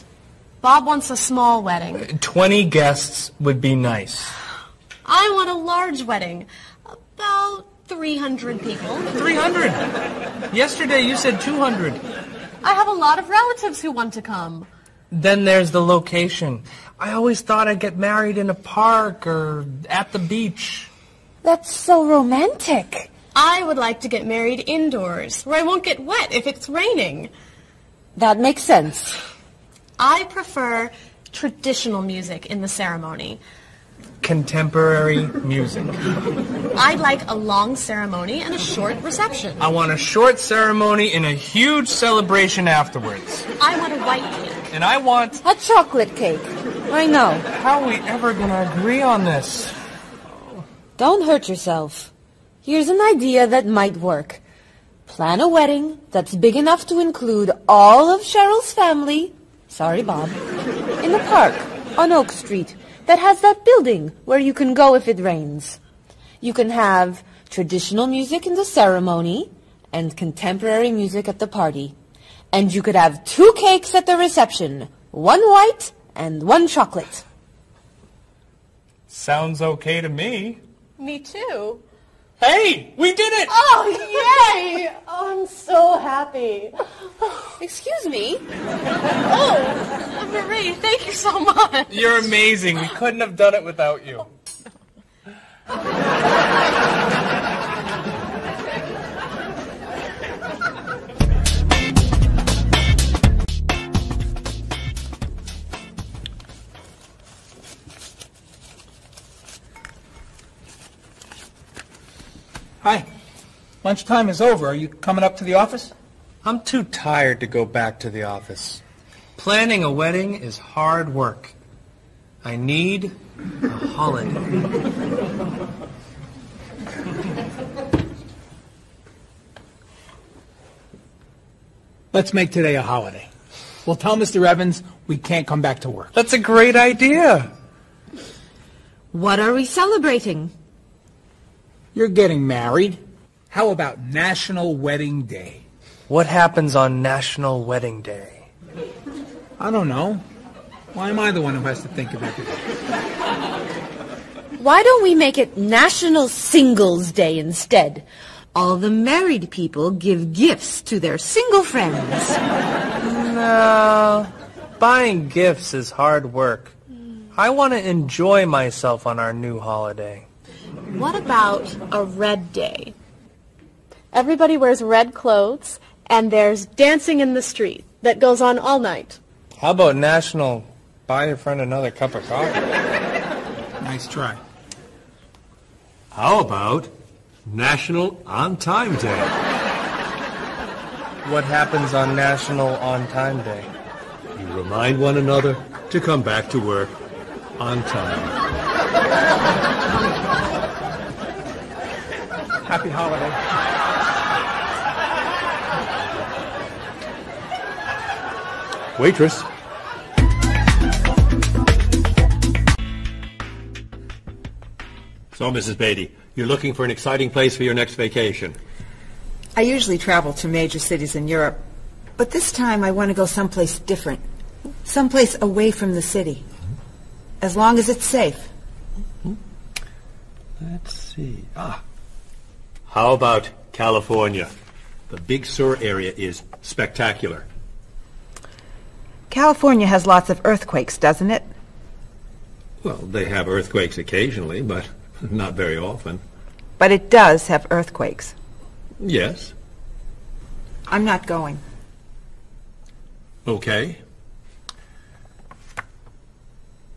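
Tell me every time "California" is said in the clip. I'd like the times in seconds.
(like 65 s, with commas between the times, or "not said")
233 s, 239 s.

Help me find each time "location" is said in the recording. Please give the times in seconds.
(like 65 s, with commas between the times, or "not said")
15 s.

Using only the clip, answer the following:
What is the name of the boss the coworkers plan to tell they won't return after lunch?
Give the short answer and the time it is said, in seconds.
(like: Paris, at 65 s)
Mr. Evans, at 134 s.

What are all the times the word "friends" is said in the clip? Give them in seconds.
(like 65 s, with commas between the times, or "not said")
161 s, 181 s.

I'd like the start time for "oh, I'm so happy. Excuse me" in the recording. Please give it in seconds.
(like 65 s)
85 s.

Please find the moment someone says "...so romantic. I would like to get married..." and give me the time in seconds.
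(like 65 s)
21 s.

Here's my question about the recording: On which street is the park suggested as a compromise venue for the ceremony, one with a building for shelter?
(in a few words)
Oak Street.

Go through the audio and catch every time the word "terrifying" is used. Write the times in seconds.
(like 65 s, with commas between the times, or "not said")
not said.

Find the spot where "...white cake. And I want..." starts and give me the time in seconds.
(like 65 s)
43 s.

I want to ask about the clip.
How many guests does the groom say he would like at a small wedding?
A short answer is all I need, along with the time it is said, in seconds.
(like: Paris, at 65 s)
20, at 2 s.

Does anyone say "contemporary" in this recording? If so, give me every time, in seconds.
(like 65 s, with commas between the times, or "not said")
34 s, 70 s.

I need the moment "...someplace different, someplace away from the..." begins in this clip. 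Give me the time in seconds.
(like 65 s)
223 s.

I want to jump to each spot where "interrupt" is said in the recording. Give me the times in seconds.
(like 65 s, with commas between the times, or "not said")
not said.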